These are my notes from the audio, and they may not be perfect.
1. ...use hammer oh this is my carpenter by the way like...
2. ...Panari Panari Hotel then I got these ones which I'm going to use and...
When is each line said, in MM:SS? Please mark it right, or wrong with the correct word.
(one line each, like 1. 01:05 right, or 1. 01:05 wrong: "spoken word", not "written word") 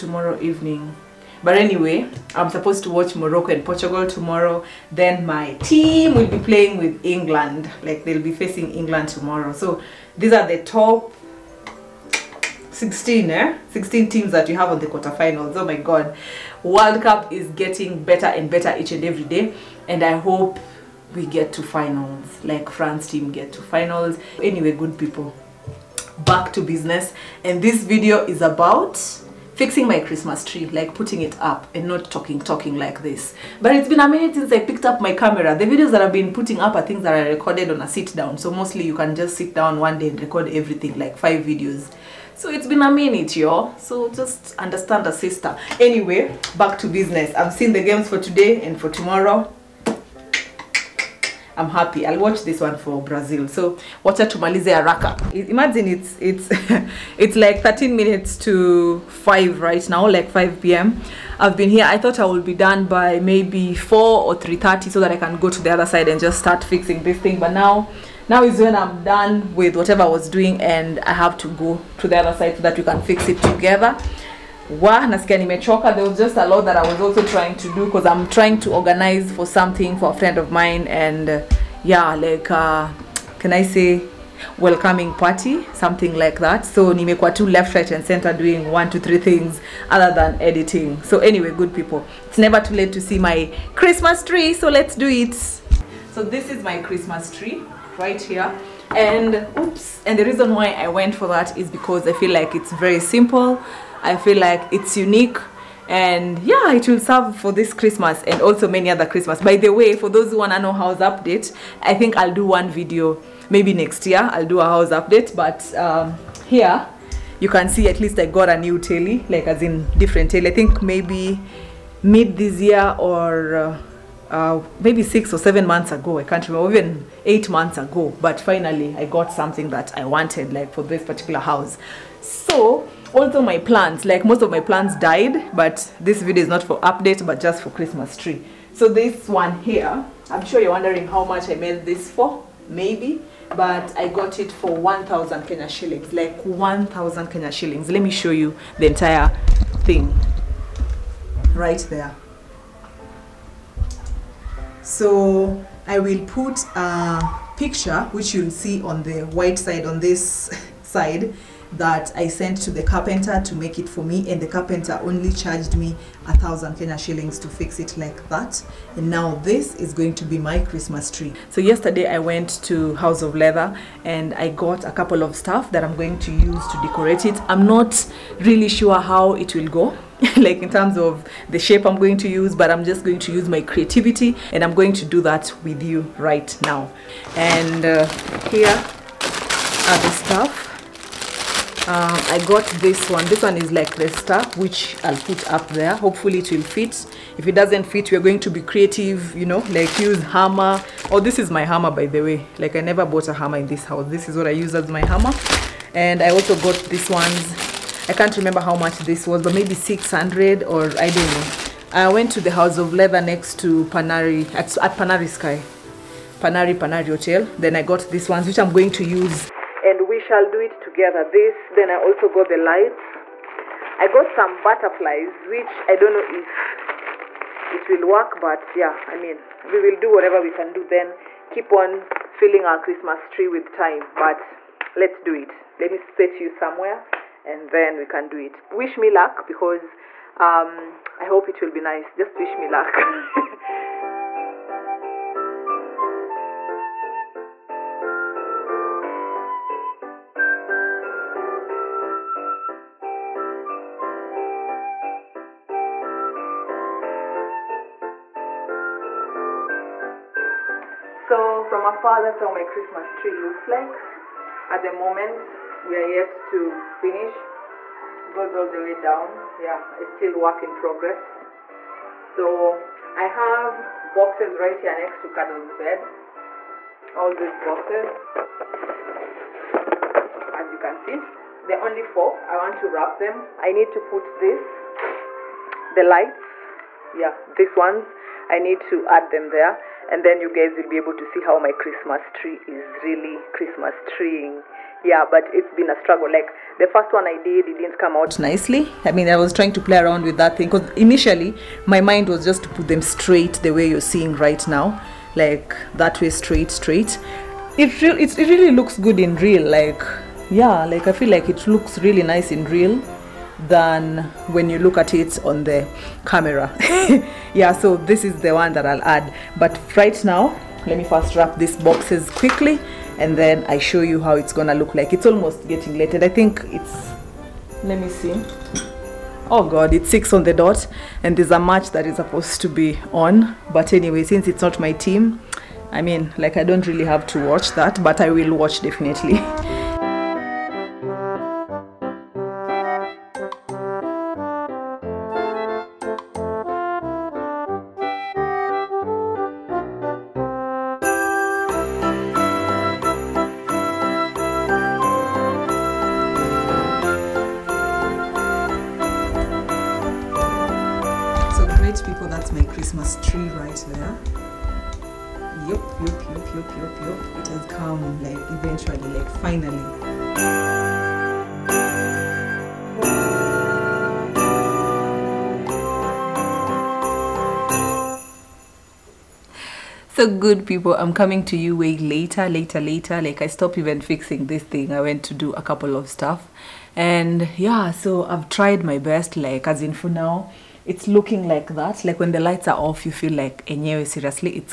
1. 03:19 wrong: "hammer", not "carpenter"
2. 03:36 right.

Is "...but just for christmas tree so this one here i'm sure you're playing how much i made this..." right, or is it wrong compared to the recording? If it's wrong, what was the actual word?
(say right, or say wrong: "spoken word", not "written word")
wrong: "wondering", not "playing".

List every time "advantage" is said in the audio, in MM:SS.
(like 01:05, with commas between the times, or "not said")
not said.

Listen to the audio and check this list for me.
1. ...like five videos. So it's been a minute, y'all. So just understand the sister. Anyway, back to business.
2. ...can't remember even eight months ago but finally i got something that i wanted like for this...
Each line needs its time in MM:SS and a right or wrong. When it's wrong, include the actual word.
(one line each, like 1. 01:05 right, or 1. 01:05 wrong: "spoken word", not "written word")
1. 00:40 right
2. 02:06 right.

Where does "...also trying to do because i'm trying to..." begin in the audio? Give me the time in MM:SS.
01:17.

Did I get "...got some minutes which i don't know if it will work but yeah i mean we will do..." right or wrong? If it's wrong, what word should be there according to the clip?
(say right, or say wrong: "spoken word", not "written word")
wrong: "butterflies", not "minutes".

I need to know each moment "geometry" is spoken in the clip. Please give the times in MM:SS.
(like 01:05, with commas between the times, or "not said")
not said.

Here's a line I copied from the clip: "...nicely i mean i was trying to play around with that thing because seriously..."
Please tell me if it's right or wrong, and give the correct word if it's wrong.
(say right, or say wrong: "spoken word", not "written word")
wrong: "initially", not "seriously".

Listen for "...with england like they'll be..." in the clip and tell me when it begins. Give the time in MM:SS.
00:06.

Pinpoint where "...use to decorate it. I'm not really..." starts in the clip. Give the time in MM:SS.
02:56.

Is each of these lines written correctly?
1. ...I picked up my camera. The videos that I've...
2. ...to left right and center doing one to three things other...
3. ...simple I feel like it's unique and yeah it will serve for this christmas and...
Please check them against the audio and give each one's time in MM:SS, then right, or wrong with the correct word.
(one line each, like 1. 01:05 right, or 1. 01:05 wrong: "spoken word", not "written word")
1. 00:34 right
2. 01:27 right
3. 01:42 right.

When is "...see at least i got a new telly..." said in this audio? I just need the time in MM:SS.
01:57.